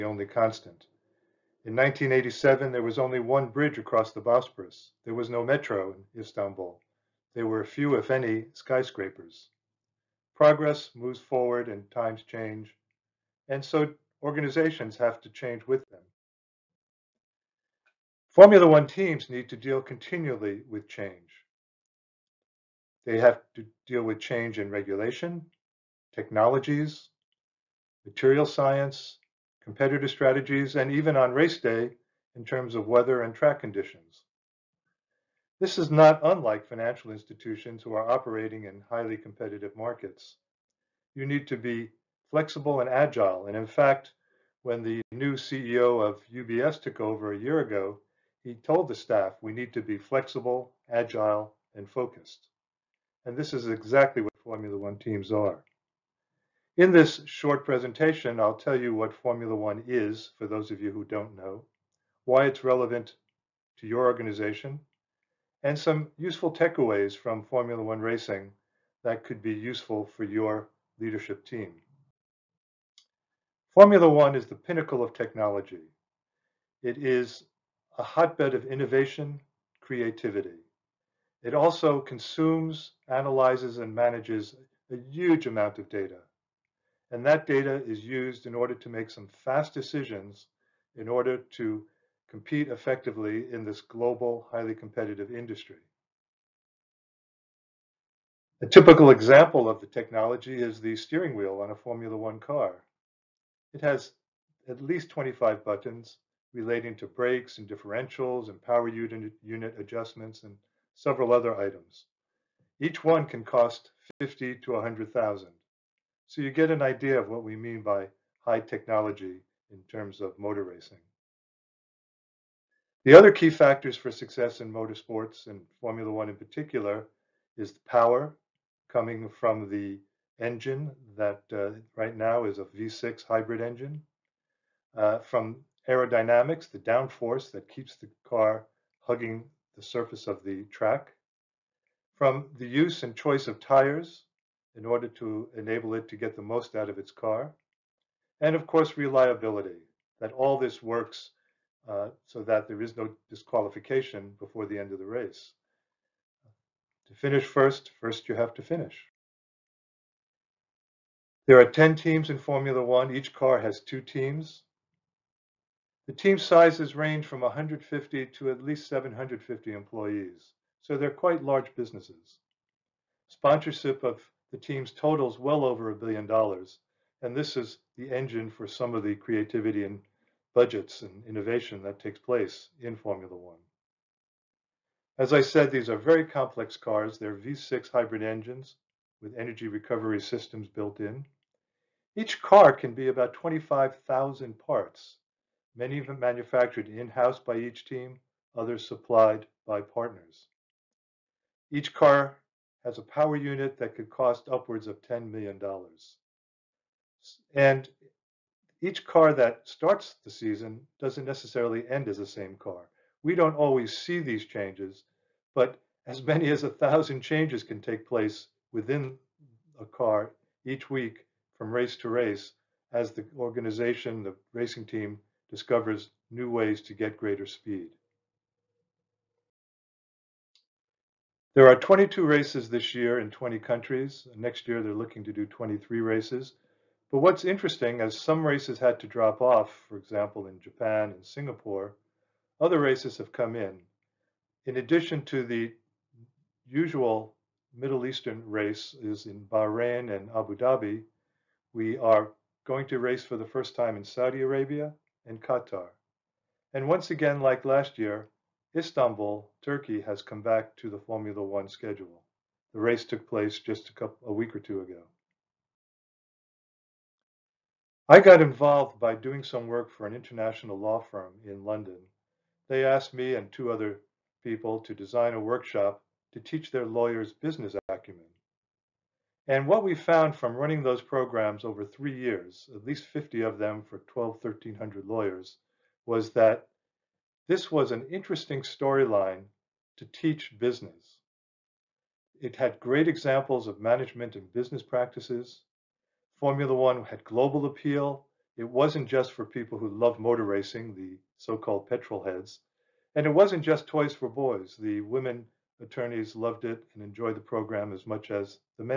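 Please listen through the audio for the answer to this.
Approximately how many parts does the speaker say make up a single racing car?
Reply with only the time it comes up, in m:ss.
3:13.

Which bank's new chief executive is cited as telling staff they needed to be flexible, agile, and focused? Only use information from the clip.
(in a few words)
UBS.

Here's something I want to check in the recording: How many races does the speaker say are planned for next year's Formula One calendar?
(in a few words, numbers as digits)
23.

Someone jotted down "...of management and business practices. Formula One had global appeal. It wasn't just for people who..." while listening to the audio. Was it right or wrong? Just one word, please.
right.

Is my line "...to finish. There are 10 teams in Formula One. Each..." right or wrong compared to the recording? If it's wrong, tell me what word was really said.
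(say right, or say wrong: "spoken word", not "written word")
right.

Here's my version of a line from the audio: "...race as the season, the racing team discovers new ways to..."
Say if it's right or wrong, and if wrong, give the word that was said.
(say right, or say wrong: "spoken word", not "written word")
wrong: "organization", not "season".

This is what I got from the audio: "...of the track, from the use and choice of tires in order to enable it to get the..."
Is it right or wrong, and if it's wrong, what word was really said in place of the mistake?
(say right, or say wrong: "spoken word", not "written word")
right.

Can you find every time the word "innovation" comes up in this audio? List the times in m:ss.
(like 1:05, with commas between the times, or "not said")
1:18, 3:01.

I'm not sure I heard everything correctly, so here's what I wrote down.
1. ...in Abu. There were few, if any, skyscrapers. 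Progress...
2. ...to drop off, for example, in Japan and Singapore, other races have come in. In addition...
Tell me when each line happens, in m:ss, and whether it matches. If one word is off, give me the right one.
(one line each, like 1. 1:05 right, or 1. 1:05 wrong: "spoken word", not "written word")
1. 0:05 wrong: "Istanbul", not "Abu"
2. 3:58 right.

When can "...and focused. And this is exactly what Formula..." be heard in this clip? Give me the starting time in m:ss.
0:51.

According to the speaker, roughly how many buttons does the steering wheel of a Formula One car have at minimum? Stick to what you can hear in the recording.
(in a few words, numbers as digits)
25.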